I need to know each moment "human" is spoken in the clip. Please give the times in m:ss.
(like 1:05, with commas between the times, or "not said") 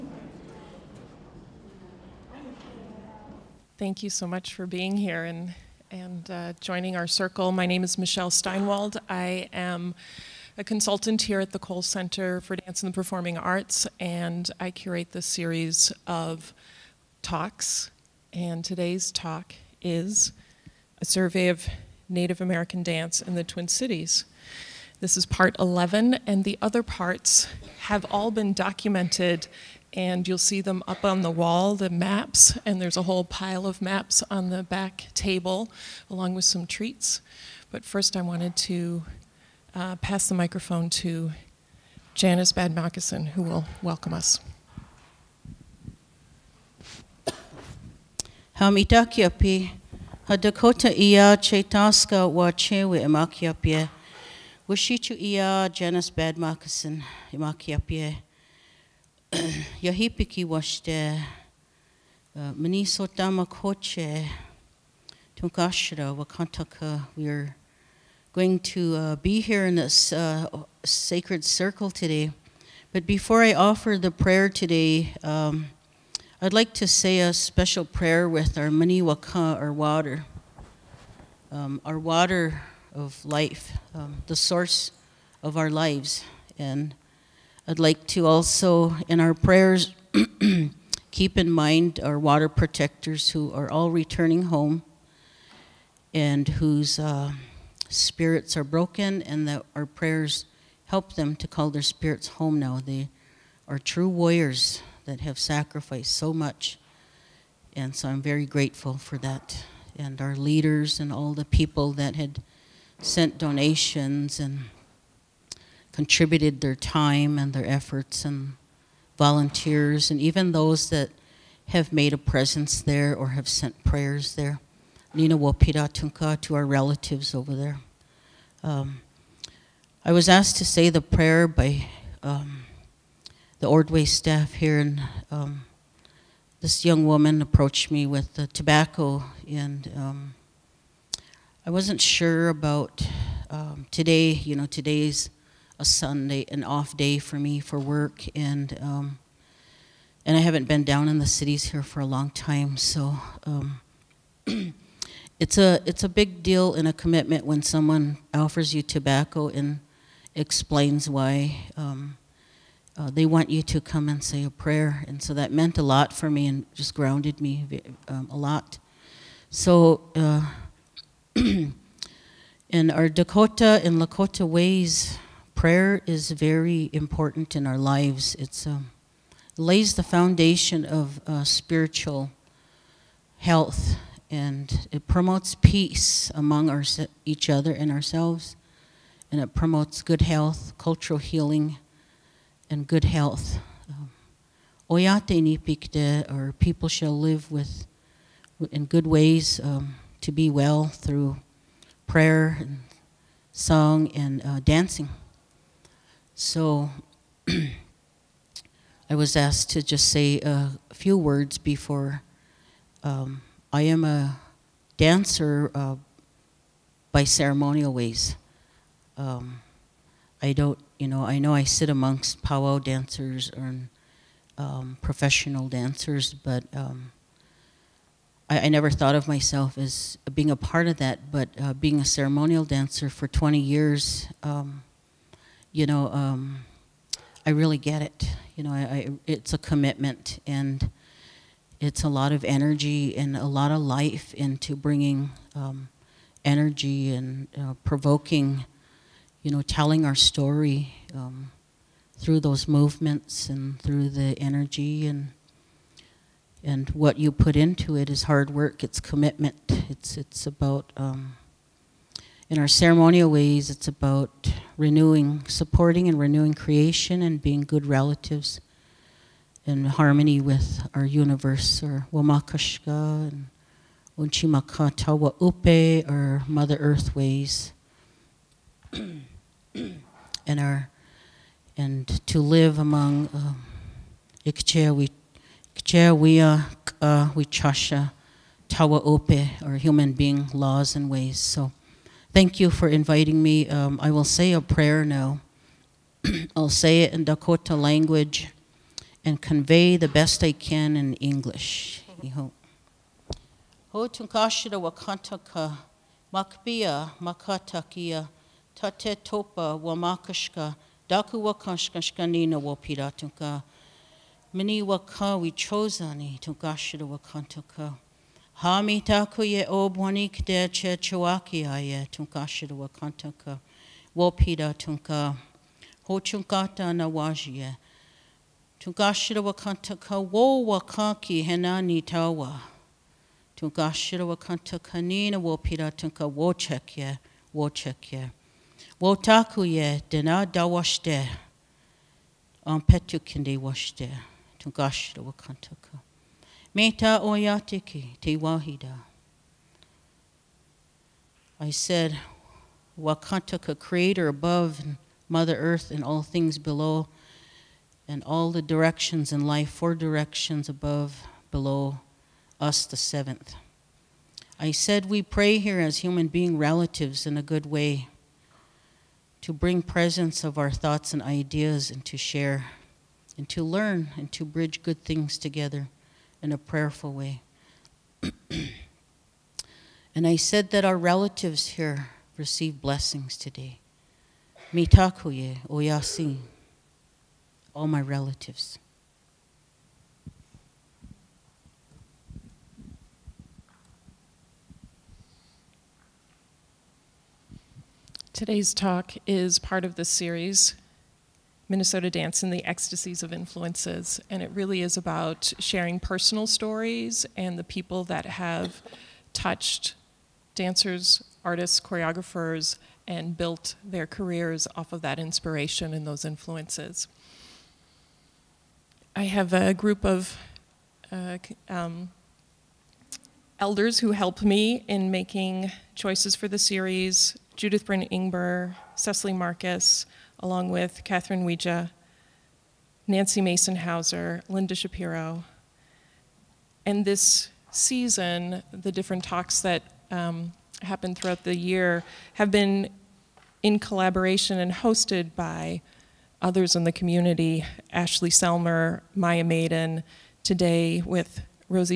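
4:49, 6:05.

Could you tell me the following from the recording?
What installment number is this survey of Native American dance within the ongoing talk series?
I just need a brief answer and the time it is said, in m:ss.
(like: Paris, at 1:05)
part 11, at 0:25.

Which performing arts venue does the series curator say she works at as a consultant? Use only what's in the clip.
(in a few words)
Cowles Center for Dance and the Performing Arts.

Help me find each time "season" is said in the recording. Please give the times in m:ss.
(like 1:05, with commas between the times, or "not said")
7:17.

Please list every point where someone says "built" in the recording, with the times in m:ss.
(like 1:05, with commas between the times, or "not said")
6:53.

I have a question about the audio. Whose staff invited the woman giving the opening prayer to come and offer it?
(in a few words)
Ordway.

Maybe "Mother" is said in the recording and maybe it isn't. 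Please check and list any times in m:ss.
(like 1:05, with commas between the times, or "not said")
4:36, 5:55.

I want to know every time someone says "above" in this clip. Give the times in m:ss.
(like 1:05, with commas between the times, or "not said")
5:54, 6:00.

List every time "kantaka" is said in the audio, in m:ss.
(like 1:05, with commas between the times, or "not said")
1:06, 5:22, 5:29, 5:34, 5:45.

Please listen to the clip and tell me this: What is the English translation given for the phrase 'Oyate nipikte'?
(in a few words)
people shall live.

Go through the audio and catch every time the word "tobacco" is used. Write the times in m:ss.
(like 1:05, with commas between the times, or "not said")
2:18, 2:38.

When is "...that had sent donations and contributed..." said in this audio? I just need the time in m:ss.
1:51.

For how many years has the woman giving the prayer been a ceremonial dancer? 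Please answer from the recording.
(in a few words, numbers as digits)
20.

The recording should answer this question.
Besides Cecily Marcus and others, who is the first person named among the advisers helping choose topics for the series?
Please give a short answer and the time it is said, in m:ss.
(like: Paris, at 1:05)
Judith Brin Ingber, at 7:07.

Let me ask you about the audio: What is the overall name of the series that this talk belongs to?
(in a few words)
Minnesota Dance and the Ecstasies of Influences.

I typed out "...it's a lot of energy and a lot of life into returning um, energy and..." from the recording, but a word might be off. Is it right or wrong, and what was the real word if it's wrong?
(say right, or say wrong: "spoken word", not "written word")
wrong: "bringing", not "returning".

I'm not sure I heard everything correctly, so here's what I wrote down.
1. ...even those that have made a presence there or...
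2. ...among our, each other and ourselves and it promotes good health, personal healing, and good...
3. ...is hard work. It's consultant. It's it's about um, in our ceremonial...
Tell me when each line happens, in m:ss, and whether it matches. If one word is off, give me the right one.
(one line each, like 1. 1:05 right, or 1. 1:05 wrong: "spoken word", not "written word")
1. 2:00 right
2. 3:06 wrong: "cultural", not "personal"
3. 4:18 wrong: "commitment", not "consultant".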